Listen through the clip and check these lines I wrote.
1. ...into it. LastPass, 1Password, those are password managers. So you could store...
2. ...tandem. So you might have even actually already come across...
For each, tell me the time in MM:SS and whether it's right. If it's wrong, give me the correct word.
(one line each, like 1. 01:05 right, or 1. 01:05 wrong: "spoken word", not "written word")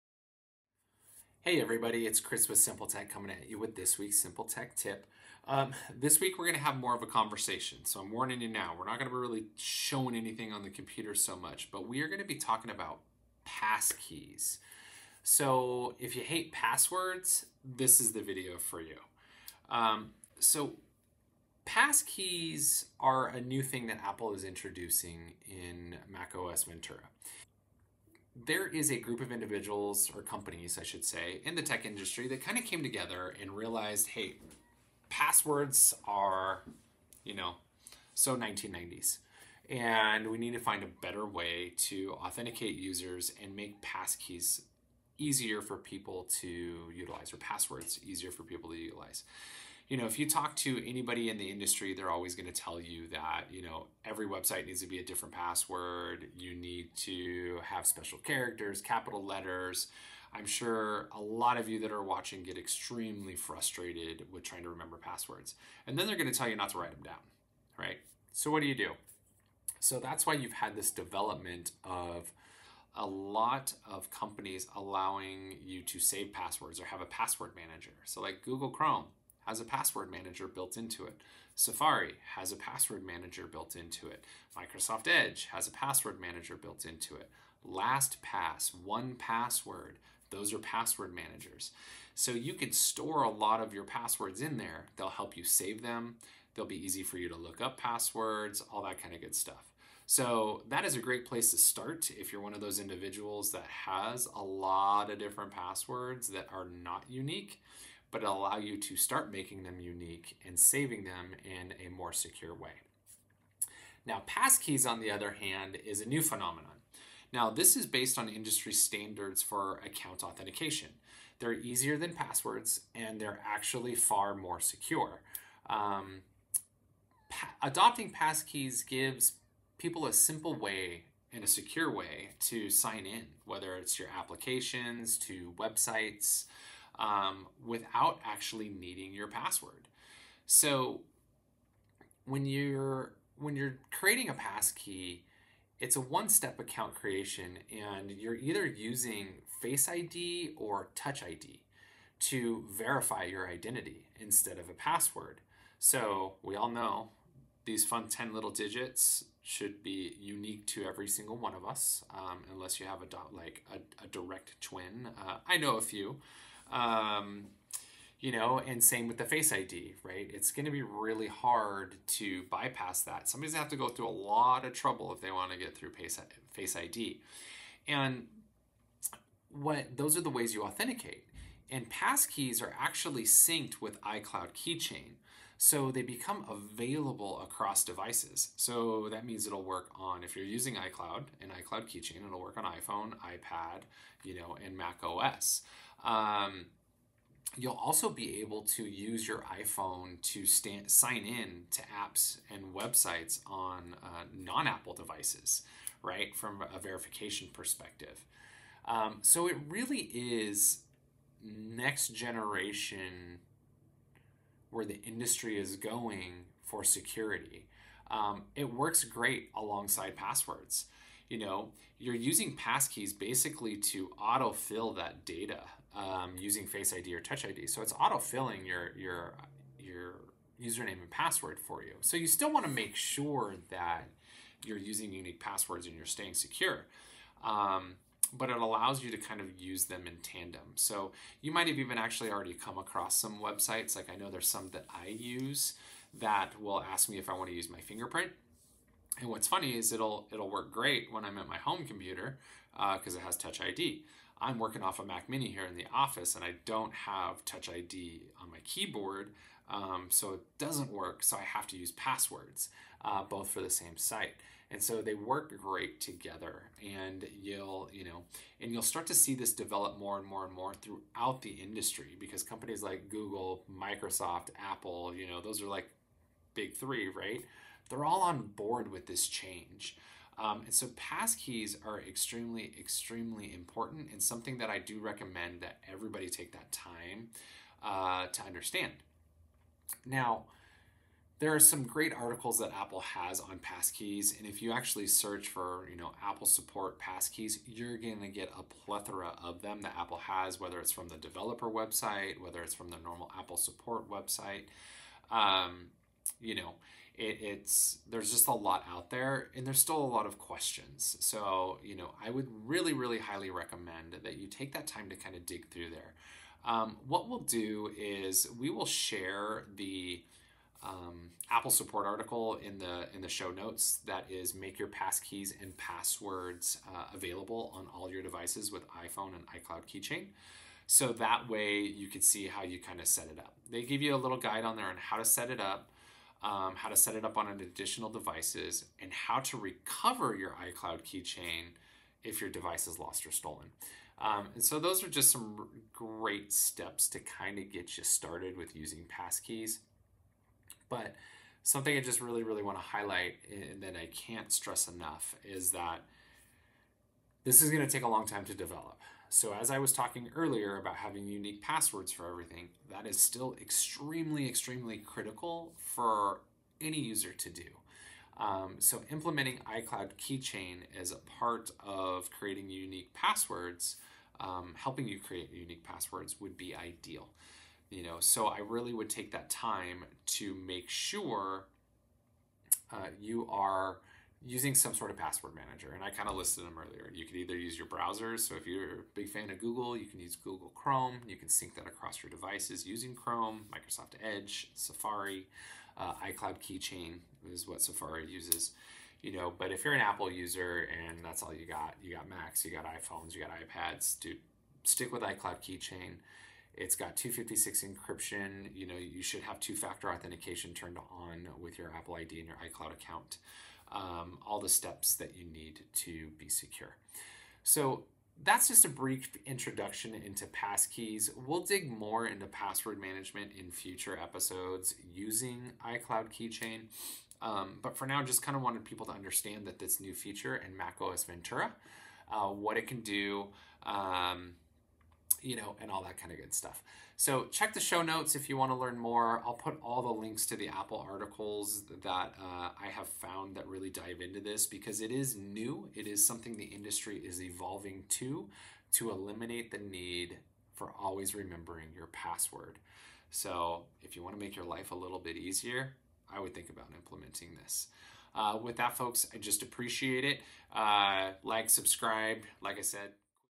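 1. 01:26 right
2. 04:00 right.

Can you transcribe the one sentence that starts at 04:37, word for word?
They're all on board with this change.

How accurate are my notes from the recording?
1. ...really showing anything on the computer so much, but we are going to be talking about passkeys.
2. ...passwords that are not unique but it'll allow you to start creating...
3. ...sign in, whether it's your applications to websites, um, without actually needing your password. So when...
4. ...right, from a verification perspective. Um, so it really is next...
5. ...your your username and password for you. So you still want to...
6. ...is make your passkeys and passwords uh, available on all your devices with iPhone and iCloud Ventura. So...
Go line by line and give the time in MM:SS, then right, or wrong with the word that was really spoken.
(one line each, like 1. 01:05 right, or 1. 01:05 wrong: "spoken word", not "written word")
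1. 00:09 right
2. 01:45 wrong: "making", not "creating"
3. 02:12 right
4. 03:26 right
5. 03:48 right
6. 05:24 wrong: "Keychain", not "Ventura".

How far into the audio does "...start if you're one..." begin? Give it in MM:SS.
01:41.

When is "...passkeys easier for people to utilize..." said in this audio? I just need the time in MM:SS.
00:43.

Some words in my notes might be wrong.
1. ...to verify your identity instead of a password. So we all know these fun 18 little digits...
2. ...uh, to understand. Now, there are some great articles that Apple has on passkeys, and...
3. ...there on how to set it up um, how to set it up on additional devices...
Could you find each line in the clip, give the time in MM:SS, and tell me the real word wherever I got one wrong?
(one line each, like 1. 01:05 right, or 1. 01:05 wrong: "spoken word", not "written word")
1. 02:32 wrong: "10", not "18"
2. 04:47 right
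3. 05:34 right.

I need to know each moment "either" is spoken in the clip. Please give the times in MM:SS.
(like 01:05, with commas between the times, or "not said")
02:28, 06:27.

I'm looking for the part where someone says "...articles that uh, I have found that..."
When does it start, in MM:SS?
07:21.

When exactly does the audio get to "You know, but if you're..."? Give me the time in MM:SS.
06:39.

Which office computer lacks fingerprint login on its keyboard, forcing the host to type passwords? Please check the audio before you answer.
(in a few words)
Mac Mini.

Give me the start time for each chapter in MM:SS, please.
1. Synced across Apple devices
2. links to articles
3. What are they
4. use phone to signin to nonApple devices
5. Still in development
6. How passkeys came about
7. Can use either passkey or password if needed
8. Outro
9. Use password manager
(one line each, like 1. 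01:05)
1. 03:05
2. 05:12
3. 02:00
4. 03:17
5. 05:54
6. 00:28
7. 04:10
8. 07:17
9. 06:20.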